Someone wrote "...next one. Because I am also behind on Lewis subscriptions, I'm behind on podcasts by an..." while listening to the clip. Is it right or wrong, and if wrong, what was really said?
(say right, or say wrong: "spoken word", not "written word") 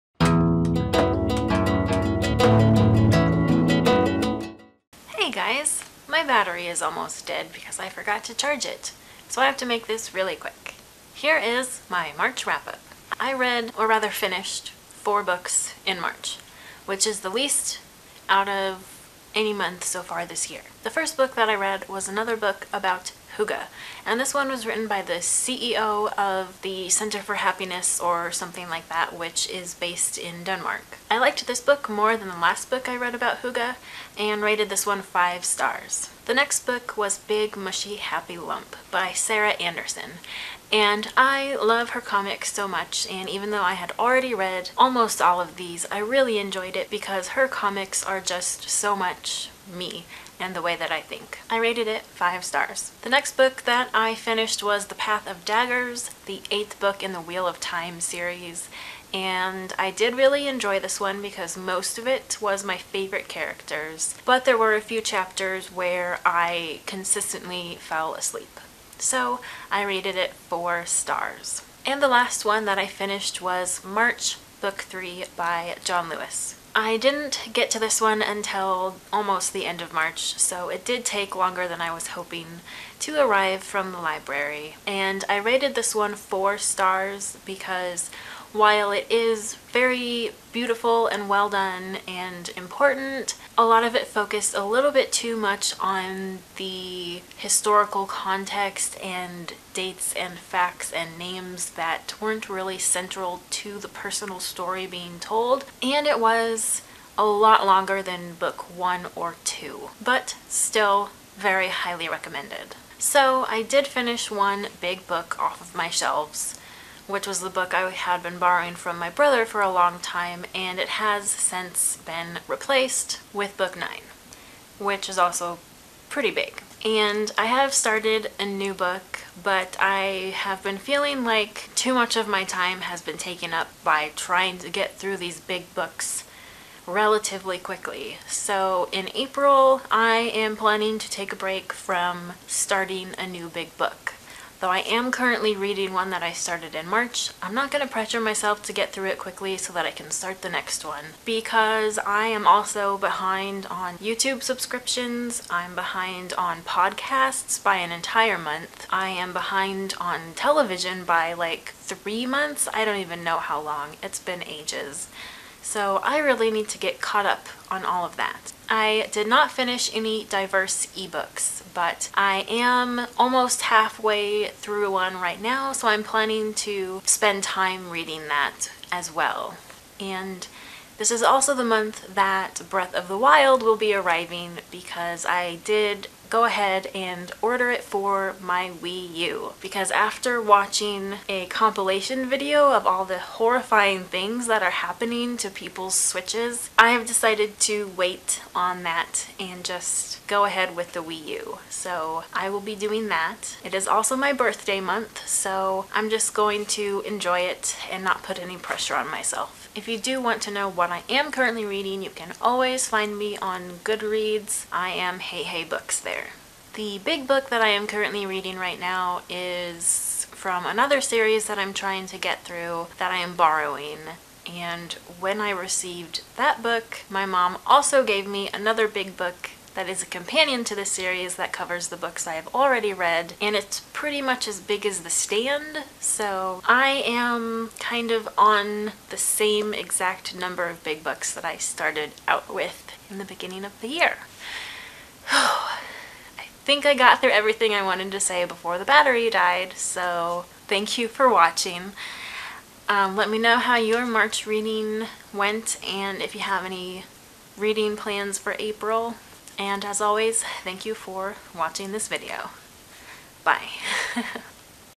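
wrong: "YouTube", not "Lewis".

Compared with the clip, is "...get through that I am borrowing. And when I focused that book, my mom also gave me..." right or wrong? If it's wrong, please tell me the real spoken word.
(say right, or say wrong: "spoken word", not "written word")
wrong: "received", not "focused".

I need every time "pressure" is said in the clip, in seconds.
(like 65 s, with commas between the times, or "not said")
147 s, 208 s.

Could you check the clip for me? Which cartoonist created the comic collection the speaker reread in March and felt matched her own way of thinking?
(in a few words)
Sarah Anderson.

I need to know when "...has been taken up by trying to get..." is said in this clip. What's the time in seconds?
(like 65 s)
132 s.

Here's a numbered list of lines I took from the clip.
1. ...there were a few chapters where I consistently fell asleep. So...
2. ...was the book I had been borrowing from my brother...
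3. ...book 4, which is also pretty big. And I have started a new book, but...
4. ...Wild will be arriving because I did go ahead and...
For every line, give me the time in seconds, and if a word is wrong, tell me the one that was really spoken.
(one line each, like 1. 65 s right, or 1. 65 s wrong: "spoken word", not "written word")
1. 64 s right
2. 117 s right
3. 123 s wrong: "9", not "4"
4. 183 s right.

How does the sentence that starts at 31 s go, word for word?
I liked this book more than the last book I read about hygge and rated this one five stars.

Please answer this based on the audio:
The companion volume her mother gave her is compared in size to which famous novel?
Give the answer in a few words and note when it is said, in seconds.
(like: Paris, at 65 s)
The Stand, at 235 s.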